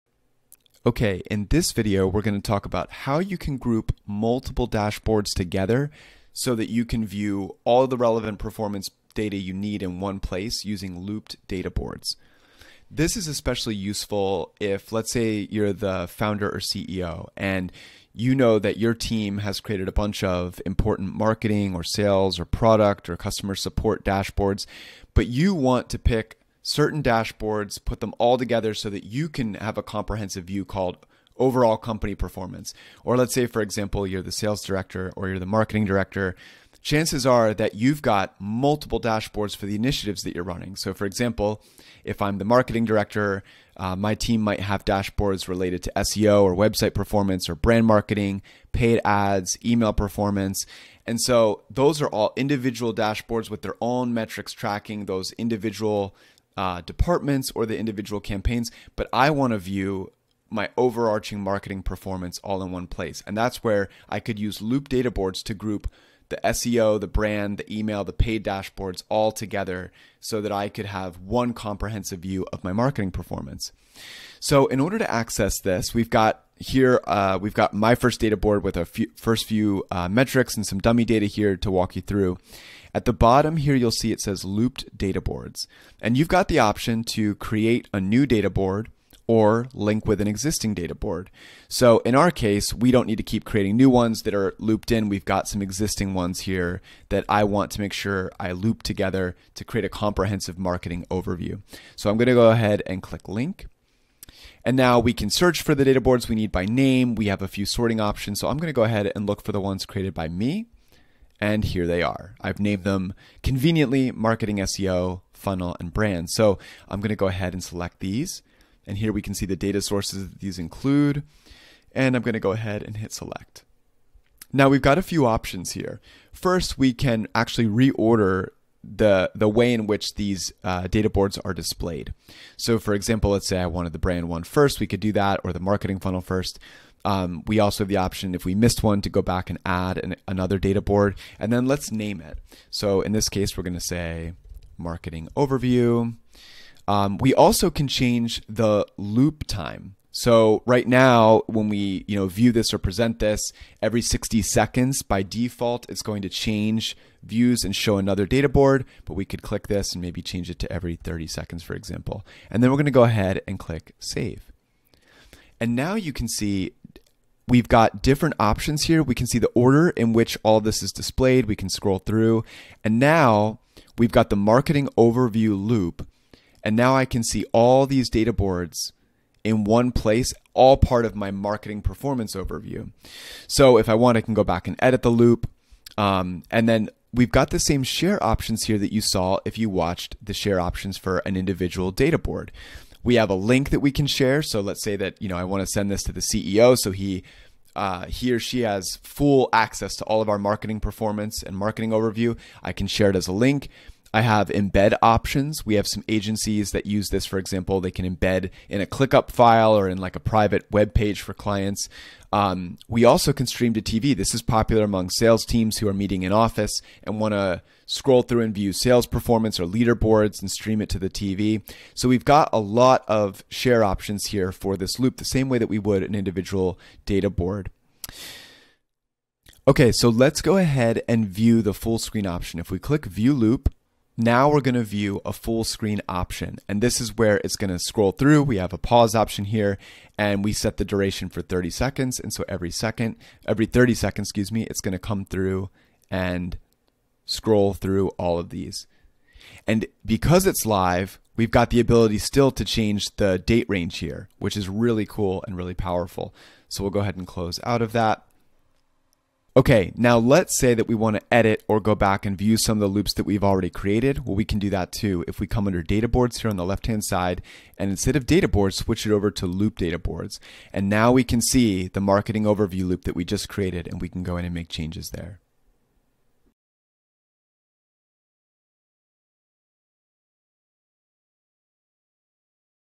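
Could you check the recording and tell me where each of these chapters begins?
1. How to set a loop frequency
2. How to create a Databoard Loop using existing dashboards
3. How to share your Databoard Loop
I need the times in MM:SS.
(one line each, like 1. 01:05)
1. 02:05
2. 01:14
3. 03:05.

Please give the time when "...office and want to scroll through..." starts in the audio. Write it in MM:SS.
03:36.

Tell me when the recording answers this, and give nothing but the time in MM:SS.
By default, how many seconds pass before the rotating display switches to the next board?
02:34.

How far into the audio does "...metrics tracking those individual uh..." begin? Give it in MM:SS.
00:54.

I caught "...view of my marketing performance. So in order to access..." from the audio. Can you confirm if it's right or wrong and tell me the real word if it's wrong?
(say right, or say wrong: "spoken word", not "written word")
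right.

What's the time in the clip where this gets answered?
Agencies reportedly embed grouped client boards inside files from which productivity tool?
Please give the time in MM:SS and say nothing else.
03:28.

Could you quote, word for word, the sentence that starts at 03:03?
So if I want, I can go back and edit the loop.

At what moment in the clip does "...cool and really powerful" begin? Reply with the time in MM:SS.
04:15.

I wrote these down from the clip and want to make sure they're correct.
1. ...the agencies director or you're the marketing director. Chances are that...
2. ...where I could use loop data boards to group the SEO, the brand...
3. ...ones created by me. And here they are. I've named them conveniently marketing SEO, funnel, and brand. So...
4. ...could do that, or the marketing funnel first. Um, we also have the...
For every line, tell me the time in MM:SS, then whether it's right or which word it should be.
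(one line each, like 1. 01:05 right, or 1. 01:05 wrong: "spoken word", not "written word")
1. 00:34 wrong: "sales", not "agencies"
2. 01:03 right
3. 01:49 right
4. 02:14 right.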